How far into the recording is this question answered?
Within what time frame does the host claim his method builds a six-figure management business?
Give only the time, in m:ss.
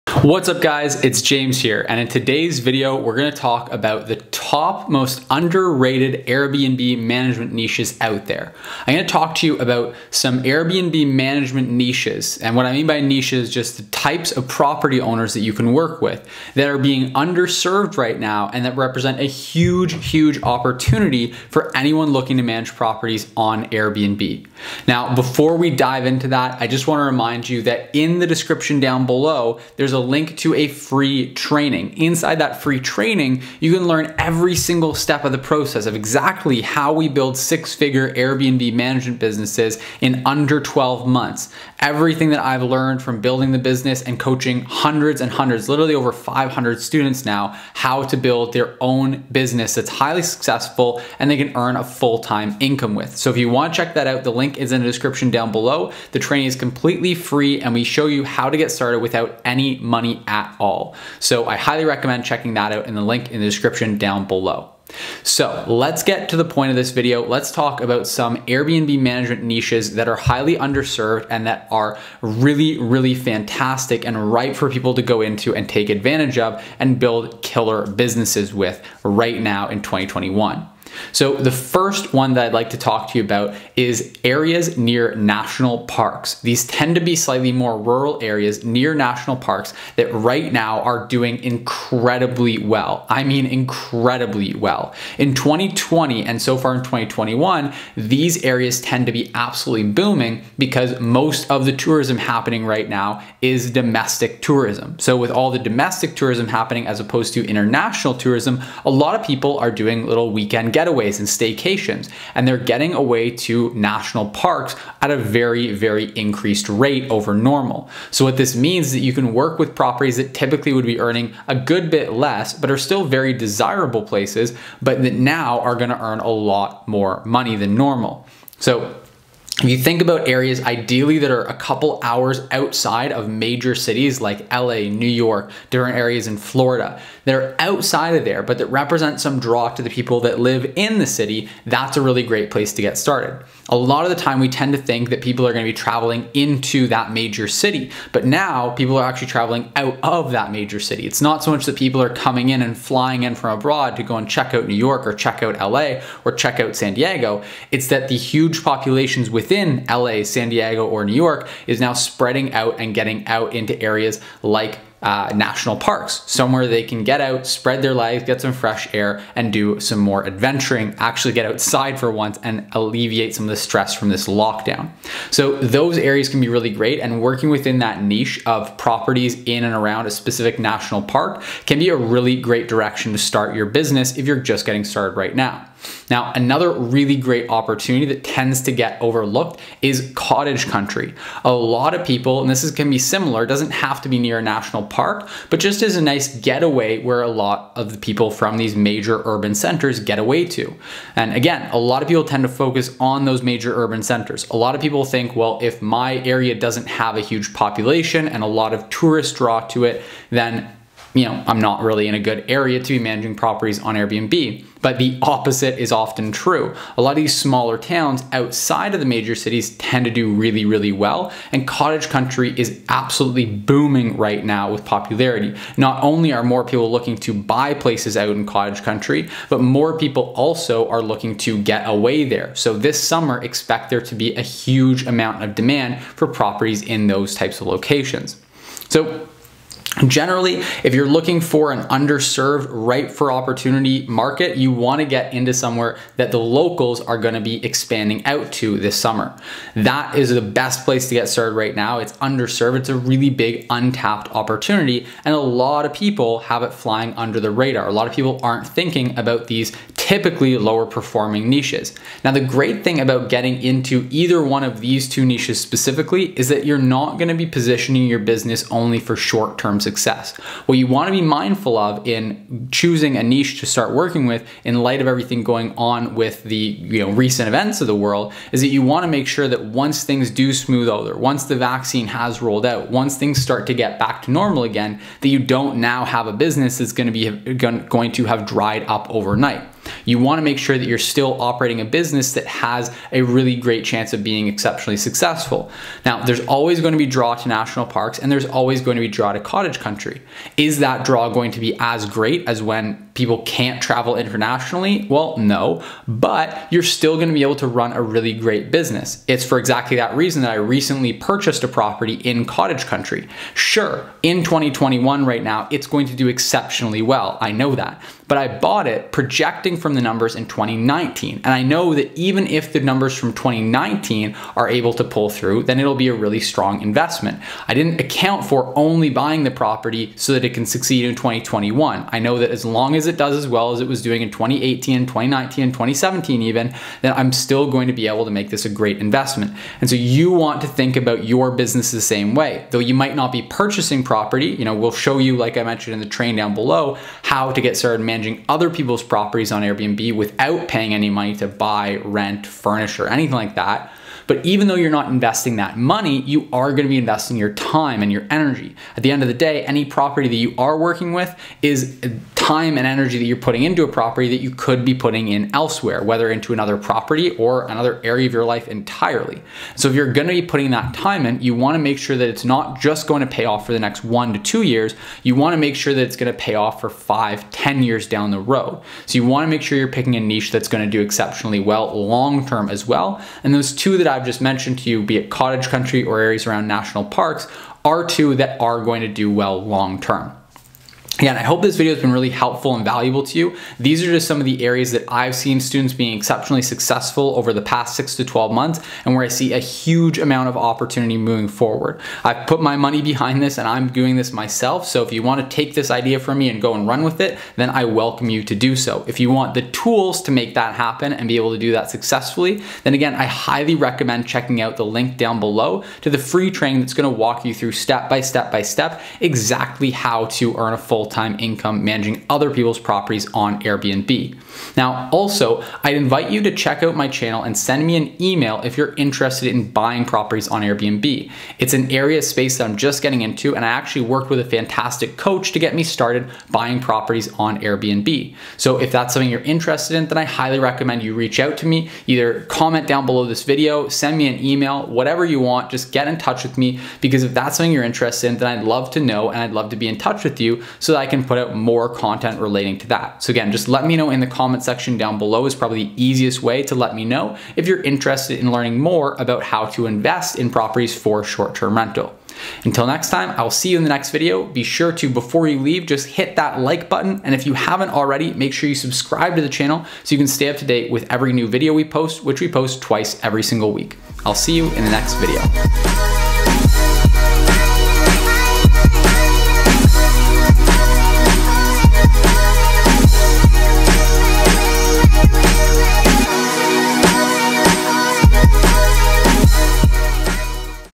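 0:40.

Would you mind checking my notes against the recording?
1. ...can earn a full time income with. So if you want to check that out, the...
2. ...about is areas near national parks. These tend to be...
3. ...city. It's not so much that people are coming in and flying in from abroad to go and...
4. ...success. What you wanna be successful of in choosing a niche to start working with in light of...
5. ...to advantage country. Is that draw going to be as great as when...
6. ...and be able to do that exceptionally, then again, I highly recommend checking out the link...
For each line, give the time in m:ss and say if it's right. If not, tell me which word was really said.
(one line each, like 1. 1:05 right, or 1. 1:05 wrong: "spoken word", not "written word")
1. 0:51 right
2. 1:23 right
3. 2:30 right
4. 4:29 wrong: "mindful", not "successful"
5. 4:59 wrong: "cottage", not "advantage"
6. 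6:51 wrong: "successfully", not "exceptionally".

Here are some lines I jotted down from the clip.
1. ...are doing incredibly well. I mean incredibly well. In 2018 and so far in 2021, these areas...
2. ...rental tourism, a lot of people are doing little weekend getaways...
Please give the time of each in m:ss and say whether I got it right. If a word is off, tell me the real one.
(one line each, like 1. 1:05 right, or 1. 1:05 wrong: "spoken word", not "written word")
1. 1:30 wrong: "2020", not "2018"
2. 1:47 wrong: "international", not "rental".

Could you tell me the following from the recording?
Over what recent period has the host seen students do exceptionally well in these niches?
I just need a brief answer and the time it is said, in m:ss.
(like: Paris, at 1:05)
six to 12 months, at 6:37.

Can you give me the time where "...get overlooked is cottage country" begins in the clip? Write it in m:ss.
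3:08.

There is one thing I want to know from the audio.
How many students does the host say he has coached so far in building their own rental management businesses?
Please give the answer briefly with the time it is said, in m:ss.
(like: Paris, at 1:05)
over 500, at 0:45.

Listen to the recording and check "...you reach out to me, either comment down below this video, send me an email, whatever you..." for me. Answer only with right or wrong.
right.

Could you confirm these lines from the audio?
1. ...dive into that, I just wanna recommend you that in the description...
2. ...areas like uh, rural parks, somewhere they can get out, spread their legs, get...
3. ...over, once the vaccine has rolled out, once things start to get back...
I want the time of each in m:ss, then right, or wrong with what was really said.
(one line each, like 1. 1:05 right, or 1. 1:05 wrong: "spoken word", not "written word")
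1. 0:25 wrong: "remind", not "recommend"
2. 2:43 wrong: "national", not "rural"
3. 4:40 right.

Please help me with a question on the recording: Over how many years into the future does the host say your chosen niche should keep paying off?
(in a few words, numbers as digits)
five, ten years.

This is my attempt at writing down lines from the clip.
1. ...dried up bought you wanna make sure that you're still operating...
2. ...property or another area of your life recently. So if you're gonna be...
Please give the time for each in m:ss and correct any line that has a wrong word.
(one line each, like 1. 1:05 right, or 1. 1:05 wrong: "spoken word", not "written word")
1. 4:48 wrong: "overnight", not "bought"
2. 6:06 wrong: "entirely", not "recently".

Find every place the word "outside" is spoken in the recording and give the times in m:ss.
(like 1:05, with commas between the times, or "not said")
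2:12, 2:17, 2:51, 3:38.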